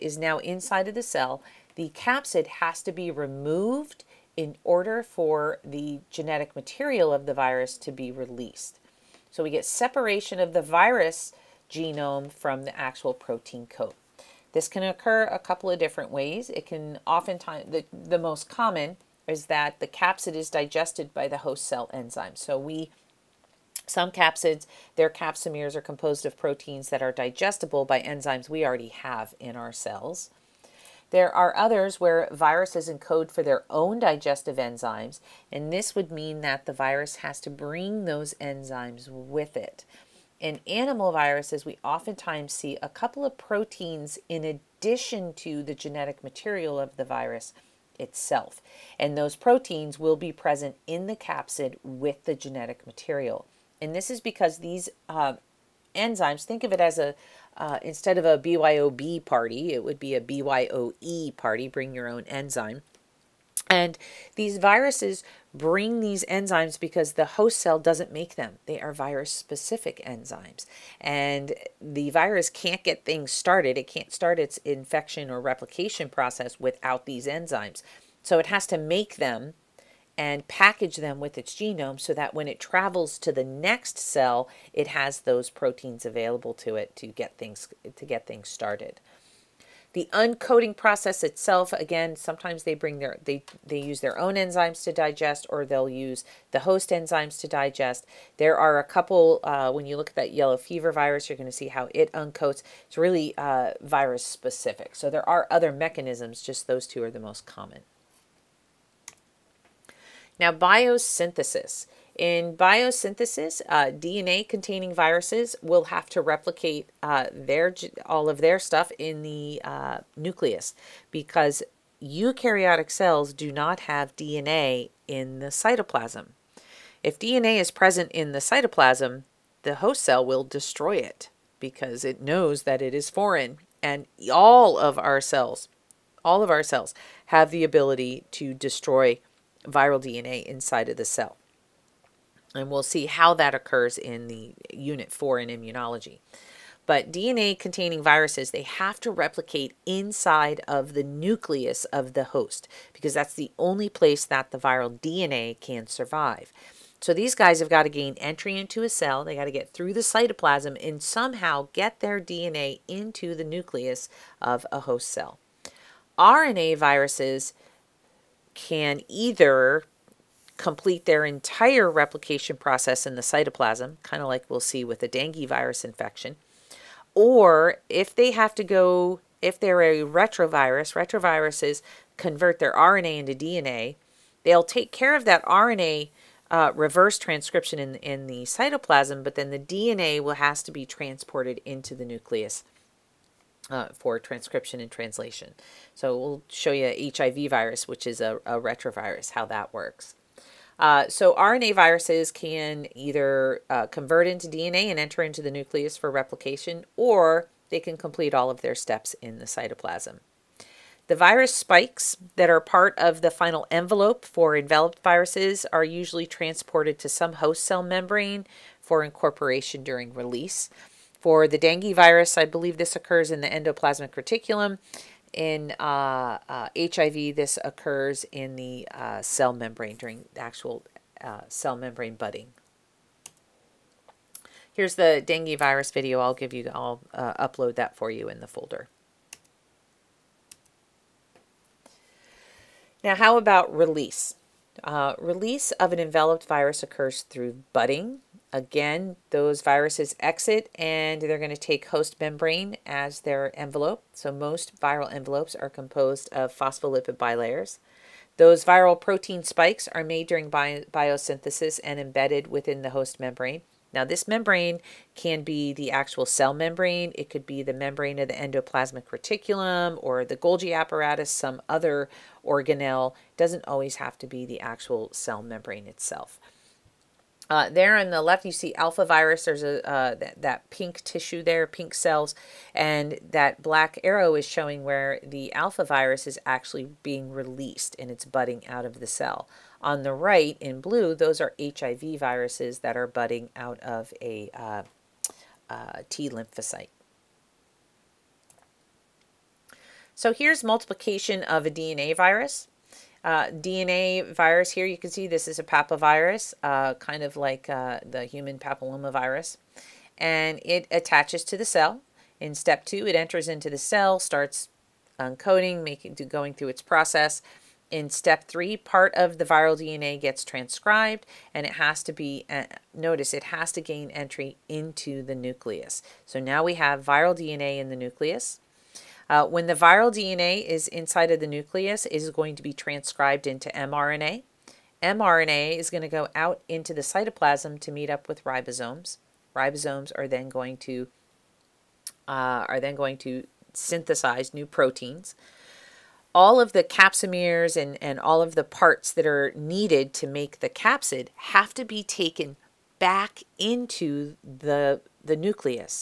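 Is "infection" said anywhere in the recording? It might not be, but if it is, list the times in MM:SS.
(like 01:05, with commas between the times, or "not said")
01:14, 02:55.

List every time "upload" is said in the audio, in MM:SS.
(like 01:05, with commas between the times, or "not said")
03:57.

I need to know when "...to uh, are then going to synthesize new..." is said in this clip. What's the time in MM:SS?
05:40.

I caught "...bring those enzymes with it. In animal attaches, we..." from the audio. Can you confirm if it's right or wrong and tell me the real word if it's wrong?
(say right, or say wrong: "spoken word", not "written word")
wrong: "viruses", not "attaches".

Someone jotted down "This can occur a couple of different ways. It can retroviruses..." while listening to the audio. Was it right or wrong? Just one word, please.
wrong.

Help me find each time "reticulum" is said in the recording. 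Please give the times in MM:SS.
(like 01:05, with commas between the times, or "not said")
03:44, 04:29.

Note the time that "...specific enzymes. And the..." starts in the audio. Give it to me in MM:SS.
01:09.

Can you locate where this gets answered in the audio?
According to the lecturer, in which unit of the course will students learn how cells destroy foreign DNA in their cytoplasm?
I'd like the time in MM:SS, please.
02:24.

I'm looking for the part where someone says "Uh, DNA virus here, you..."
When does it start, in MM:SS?
05:03.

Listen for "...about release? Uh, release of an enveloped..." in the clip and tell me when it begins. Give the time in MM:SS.
04:03.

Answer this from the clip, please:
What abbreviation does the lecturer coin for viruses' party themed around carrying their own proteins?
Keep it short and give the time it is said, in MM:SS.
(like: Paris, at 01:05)
BYOE, at 01:00.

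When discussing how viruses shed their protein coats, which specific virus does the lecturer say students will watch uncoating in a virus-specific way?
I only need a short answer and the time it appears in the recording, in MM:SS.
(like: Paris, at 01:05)
yellow fever virus, at 01:40.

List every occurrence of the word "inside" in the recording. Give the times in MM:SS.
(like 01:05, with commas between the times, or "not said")
00:00, 02:20, 02:29, 05:30.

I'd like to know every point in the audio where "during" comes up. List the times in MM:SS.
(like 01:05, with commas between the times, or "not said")
03:39, 03:49, 04:20.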